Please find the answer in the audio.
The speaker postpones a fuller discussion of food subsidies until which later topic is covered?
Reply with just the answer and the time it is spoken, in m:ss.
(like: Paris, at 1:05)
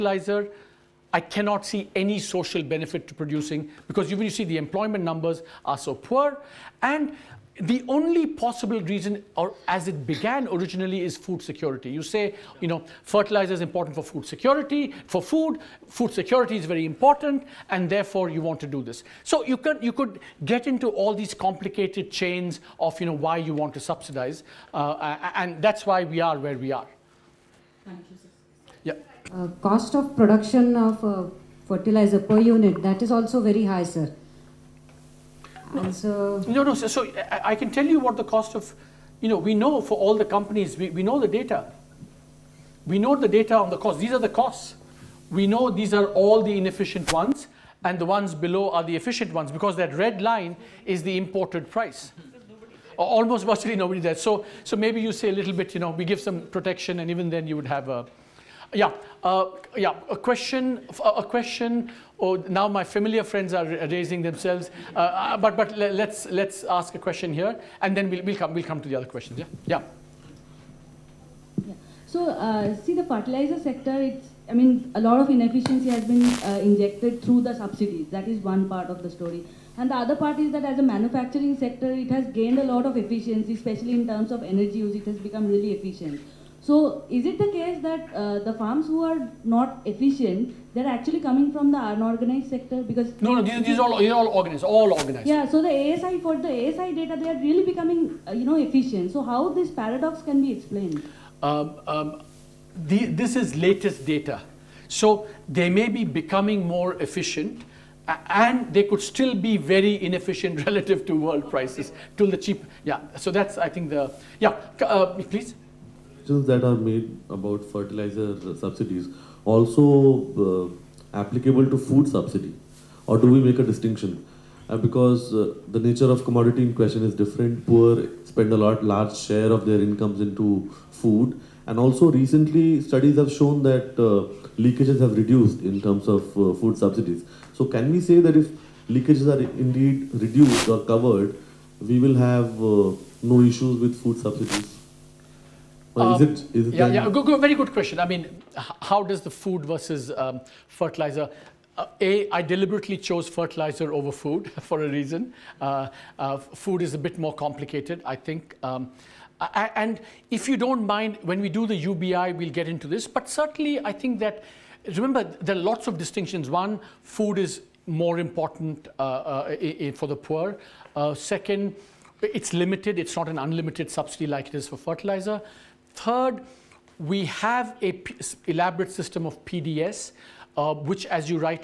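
UBI, at 2:41.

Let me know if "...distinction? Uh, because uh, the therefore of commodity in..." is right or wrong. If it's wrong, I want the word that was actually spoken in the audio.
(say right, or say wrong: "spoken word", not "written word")
wrong: "nature", not "therefore".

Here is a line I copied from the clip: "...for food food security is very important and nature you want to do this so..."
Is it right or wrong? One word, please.
wrong.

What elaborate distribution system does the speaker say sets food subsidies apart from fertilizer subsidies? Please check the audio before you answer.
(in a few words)
PDS.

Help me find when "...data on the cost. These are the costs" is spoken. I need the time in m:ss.
0:43.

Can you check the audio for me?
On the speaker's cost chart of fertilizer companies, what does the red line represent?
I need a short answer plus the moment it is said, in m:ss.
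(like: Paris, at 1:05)
imported price, at 0:51.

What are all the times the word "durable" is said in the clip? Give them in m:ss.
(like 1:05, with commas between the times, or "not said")
not said.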